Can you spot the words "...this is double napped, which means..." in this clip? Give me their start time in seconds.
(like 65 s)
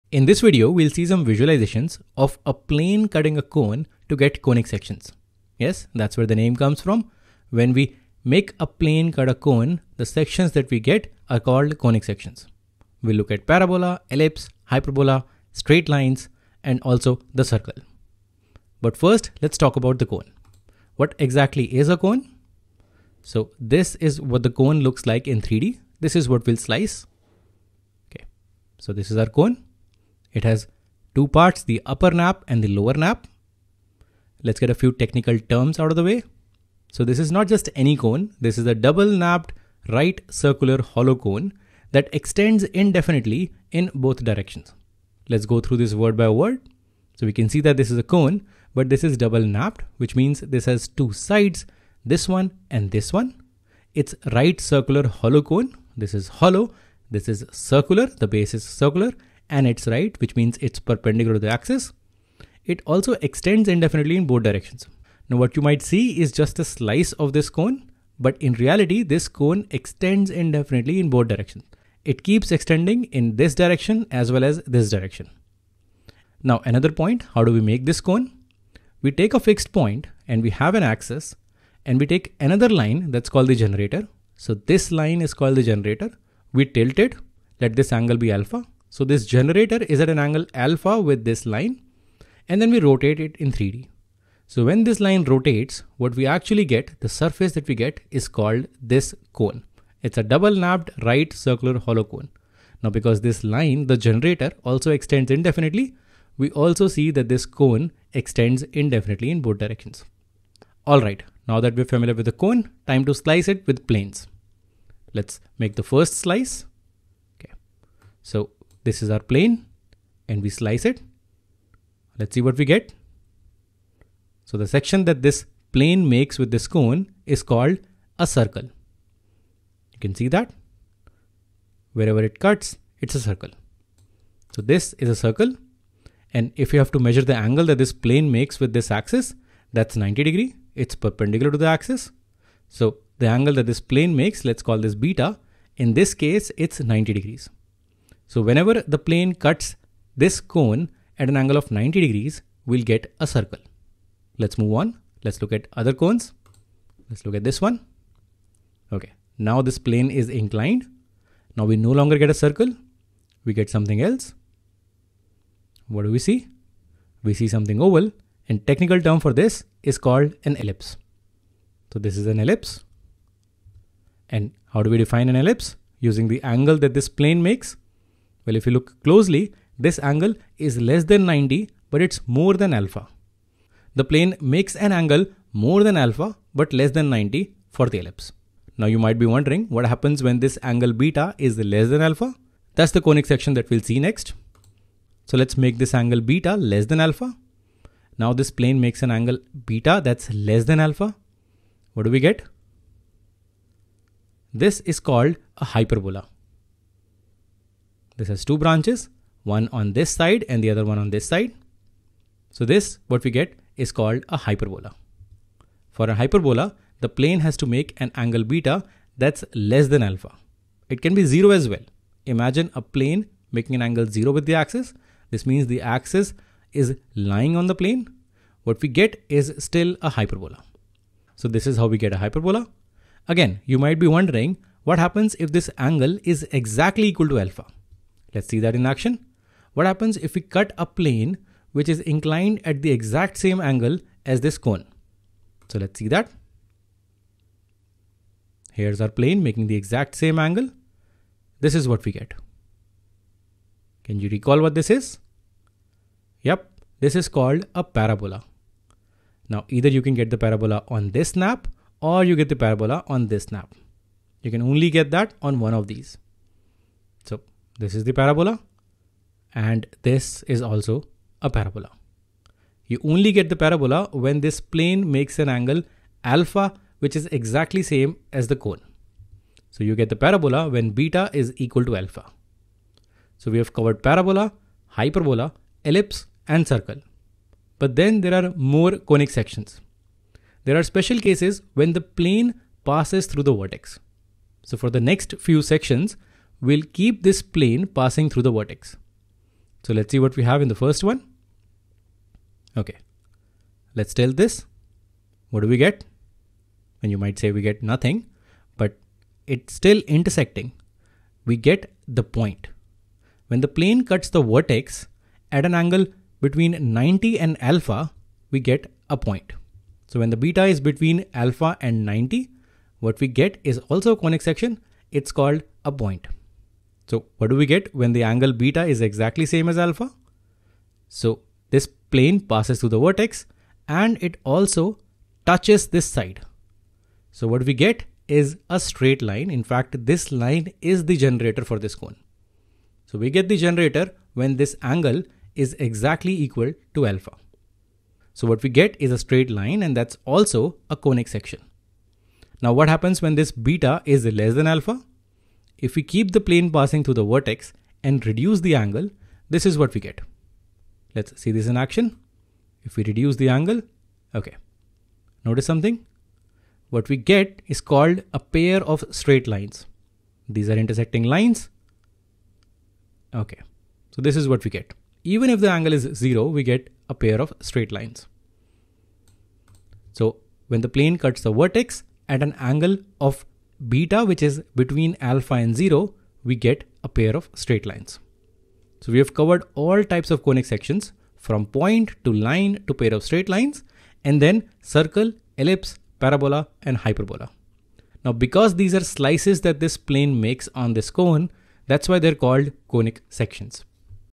48 s.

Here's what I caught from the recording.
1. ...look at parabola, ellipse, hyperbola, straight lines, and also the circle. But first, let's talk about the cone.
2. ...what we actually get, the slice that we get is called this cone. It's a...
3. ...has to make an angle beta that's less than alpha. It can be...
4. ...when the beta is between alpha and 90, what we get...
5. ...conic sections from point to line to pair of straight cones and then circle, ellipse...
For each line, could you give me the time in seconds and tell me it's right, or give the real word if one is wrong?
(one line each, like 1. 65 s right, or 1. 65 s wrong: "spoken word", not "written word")
1. 13 s right
2. 95 s wrong: "surface", not "slice"
3. 217 s right
4. 320 s right
5. 390 s wrong: "lines", not "cones".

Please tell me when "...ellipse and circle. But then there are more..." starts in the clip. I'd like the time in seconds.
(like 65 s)
285 s.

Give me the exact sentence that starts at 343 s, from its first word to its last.
So we get the generator when this angle is exactly equal to alpha.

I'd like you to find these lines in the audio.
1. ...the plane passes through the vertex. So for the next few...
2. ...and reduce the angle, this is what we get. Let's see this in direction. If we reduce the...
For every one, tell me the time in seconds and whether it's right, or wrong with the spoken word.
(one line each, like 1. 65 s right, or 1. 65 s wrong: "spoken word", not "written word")
1. 291 s right
2. 358 s wrong: "action", not "direction".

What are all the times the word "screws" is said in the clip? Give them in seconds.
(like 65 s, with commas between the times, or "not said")
not said.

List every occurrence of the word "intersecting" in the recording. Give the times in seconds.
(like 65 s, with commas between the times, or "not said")
310 s, 370 s.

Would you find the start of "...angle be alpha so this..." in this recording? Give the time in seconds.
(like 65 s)
87 s.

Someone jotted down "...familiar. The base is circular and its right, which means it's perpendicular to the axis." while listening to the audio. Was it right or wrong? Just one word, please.
wrong.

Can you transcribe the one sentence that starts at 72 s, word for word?
It keeps extending in this direction as well as this direction.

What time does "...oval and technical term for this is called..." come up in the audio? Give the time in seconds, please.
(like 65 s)
167 s.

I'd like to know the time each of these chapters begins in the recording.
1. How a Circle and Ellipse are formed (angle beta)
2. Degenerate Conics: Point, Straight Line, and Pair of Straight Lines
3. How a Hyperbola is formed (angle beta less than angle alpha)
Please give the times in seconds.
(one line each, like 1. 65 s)
1. 110 s
2. 290 s
3. 195 s.